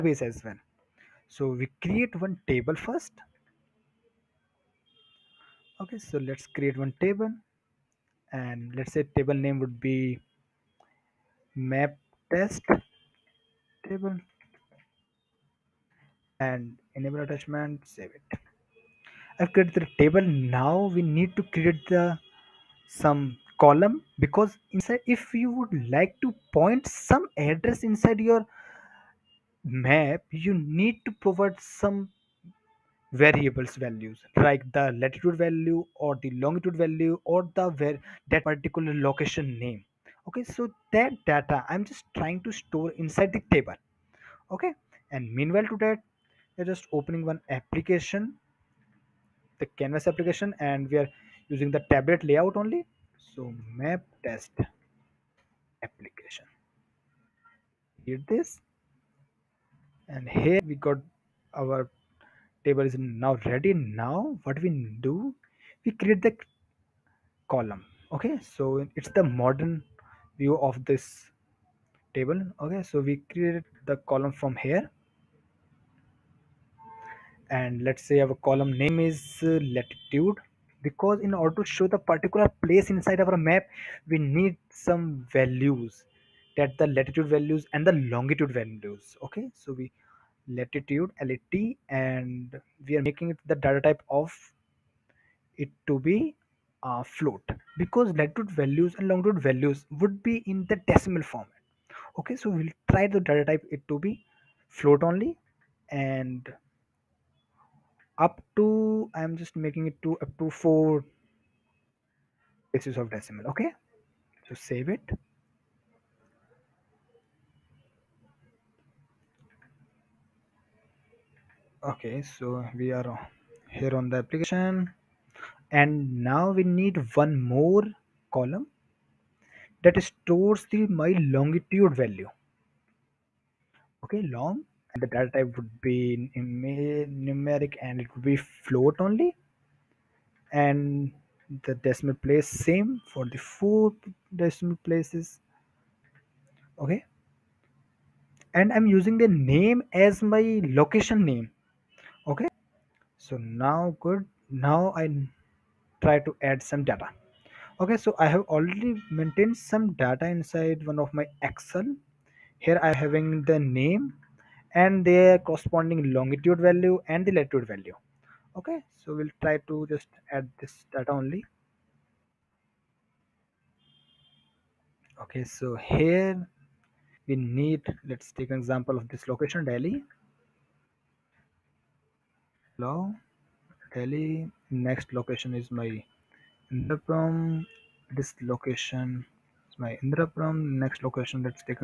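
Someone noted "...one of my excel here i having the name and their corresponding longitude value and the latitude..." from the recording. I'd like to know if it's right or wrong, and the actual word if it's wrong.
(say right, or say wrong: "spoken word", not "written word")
right.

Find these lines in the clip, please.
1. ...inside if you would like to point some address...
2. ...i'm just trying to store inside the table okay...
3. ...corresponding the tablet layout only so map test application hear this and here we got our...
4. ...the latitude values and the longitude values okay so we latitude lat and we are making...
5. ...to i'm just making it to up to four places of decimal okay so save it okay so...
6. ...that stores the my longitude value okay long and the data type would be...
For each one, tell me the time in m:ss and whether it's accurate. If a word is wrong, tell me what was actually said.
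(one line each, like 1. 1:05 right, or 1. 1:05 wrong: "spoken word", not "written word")
1. 0:24 right
2. 0:41 right
3. 0:51 wrong: "using", not "corresponding"
4. 1:26 right
5. 1:48 right
6. 2:09 right.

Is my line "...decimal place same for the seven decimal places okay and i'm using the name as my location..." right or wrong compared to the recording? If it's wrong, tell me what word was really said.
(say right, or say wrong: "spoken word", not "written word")
wrong: "four", not "seven".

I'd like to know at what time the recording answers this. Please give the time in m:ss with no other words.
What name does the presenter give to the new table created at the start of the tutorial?
0:11.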